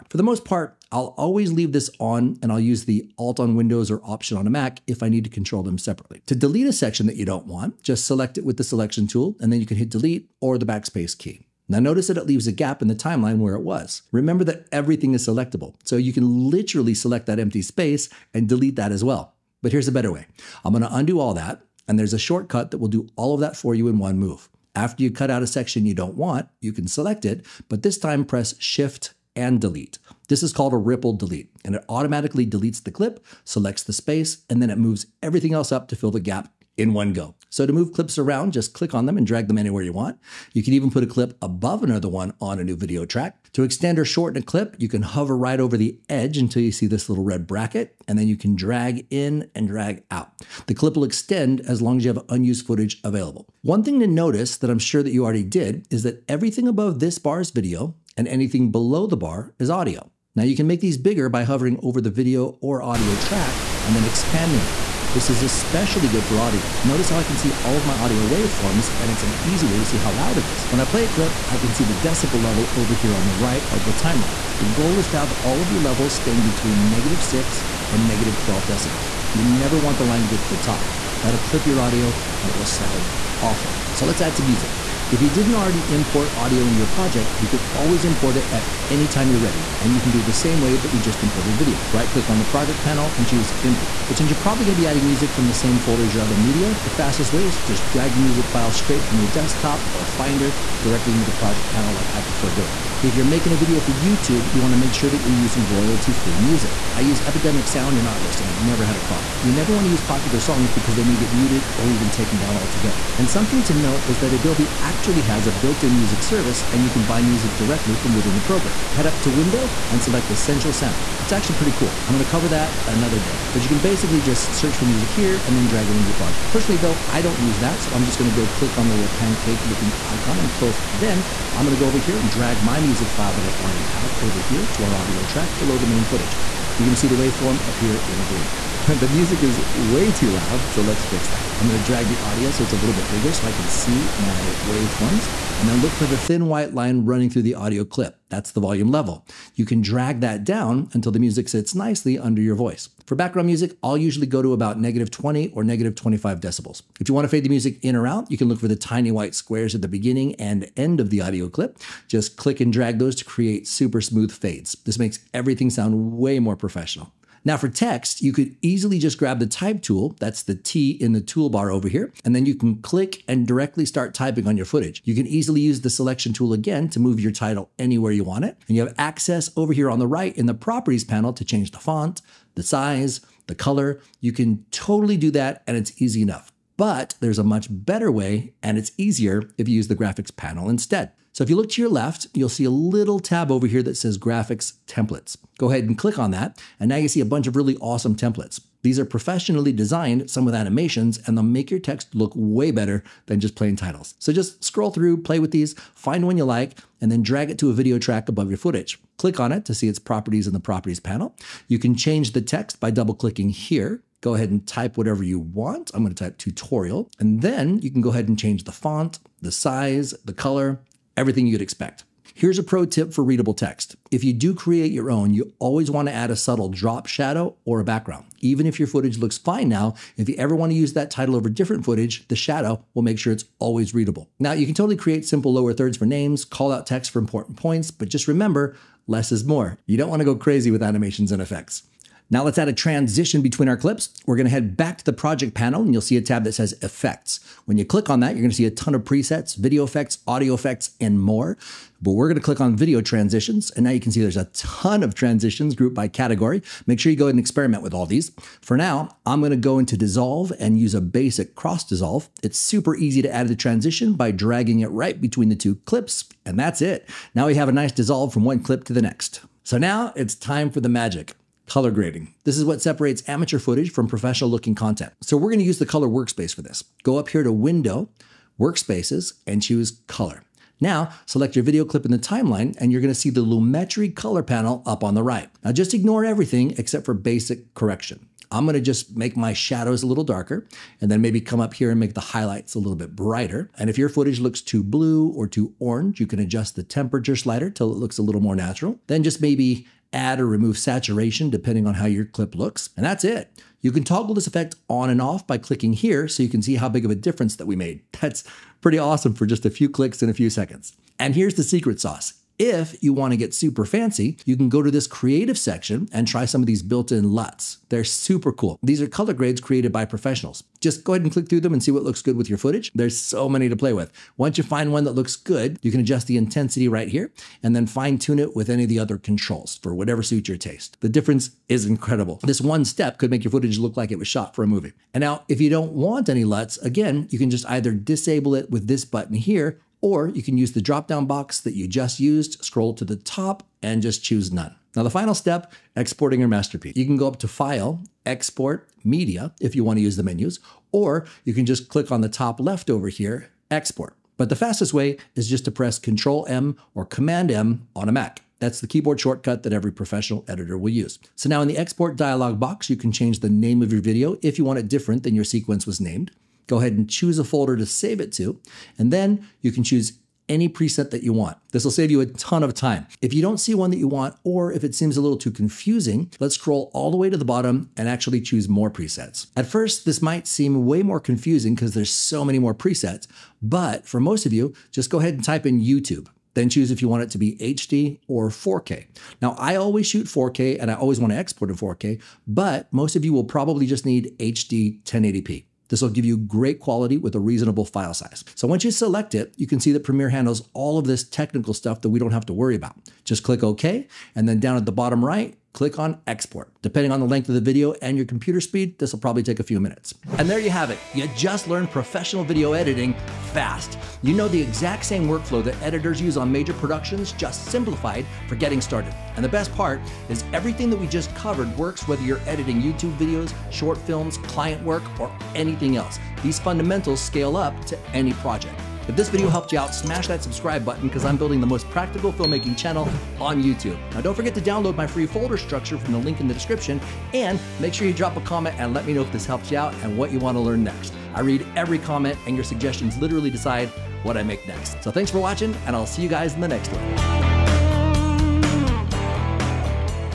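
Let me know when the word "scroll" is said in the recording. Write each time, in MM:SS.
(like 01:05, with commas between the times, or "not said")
03:24, 05:42, 06:16.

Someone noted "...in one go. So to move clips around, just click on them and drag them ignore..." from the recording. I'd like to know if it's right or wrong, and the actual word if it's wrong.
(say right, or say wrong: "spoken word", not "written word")
wrong: "anywhere", not "ignore".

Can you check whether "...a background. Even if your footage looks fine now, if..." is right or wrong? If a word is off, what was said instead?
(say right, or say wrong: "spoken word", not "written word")
right.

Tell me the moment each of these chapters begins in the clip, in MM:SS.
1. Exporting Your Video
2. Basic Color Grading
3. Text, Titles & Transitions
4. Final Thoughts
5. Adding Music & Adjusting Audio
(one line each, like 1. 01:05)
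1. 05:44
2. 04:28
3. 02:46
4. 06:48
5. 01:23.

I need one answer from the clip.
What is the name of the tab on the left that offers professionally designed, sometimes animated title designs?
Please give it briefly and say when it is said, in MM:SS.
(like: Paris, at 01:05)
Graphics templates, at 03:14.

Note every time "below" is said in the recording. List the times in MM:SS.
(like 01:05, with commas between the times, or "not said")
00:58, 02:15.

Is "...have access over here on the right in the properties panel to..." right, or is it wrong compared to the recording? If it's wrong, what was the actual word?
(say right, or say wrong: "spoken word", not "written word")
right.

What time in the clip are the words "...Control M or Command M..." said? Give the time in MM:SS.
05:55.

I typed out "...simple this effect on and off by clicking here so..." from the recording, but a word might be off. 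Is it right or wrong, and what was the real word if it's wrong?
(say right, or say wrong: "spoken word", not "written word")
wrong: "toggle", not "simple".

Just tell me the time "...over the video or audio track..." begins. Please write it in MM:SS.
01:01.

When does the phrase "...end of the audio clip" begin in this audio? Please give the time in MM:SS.
02:40.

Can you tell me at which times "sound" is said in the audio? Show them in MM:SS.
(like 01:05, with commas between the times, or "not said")
01:22, 01:47, 02:00, 02:45.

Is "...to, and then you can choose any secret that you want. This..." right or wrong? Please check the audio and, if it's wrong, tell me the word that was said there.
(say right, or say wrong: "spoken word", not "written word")
wrong: "preset", not "secret".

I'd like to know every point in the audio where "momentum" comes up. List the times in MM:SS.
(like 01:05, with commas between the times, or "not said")
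not said.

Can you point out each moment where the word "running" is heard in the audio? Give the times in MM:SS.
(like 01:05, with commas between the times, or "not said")
02:27.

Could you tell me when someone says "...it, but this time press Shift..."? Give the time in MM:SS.
00:27.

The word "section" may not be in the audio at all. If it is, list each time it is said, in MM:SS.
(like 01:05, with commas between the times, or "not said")
00:06, 00:25, 05:15.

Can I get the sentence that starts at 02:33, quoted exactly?
For background music, I'll usually go to about negative 20 or negative 25 decibels.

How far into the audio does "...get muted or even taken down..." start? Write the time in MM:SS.
01:51.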